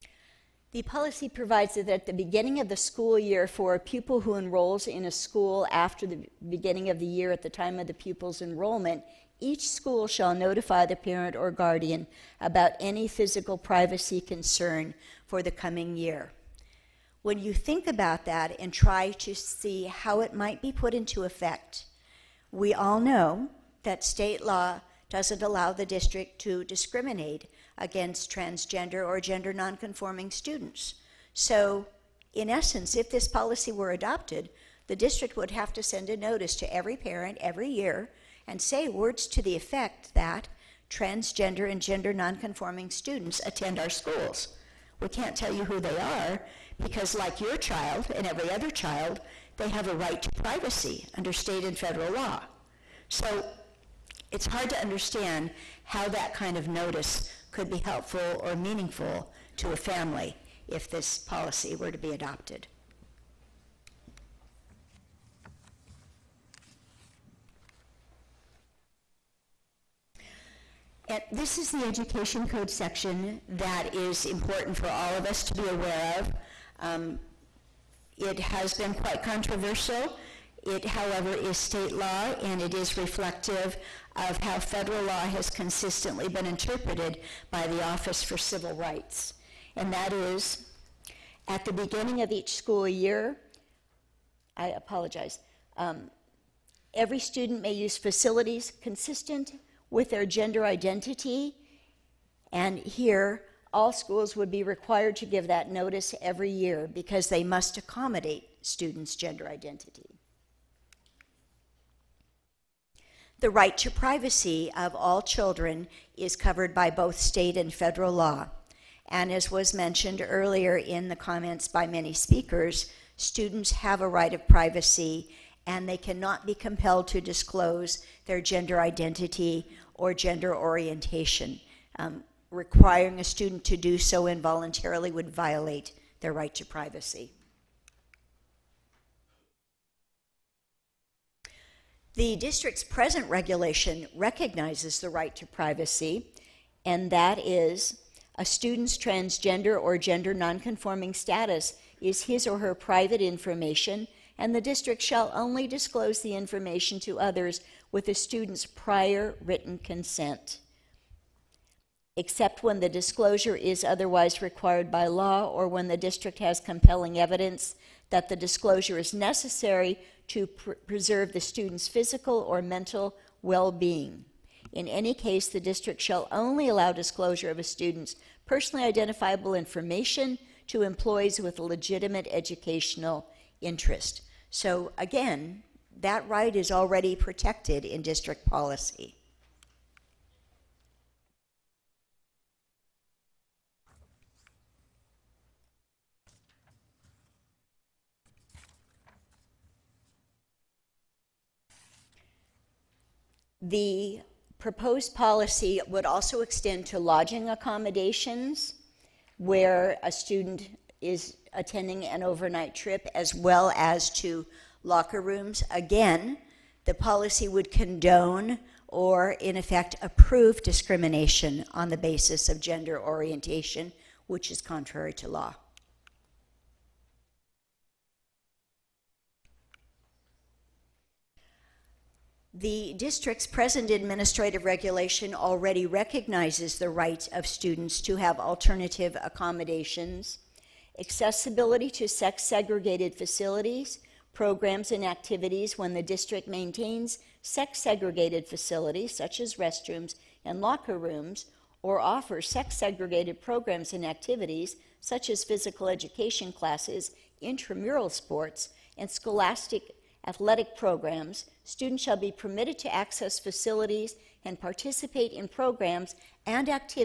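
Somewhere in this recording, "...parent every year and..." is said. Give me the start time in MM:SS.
00:36.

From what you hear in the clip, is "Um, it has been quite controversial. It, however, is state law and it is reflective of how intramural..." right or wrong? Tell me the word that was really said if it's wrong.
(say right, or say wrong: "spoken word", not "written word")
wrong: "federal", not "intramural".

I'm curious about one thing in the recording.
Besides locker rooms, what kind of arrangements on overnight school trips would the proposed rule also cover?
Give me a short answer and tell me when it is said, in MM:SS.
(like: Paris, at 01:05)
lodging accommodations, at 03:26.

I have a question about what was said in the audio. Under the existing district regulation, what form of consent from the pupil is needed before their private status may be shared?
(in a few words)
prior written consent.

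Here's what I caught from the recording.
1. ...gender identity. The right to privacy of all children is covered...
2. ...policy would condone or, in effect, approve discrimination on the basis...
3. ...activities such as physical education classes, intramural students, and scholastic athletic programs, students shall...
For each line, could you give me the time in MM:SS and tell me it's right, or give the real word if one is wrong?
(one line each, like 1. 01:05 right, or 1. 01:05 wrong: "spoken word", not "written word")
1. 01:49 right
2. 03:36 right
3. 04:14 wrong: "sports", not "students".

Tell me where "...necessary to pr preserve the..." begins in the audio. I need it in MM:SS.
02:49.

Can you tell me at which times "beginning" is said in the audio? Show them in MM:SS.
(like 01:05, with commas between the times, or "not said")
00:02, 00:06, 01:31.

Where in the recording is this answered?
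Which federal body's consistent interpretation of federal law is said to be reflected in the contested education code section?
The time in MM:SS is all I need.
01:27.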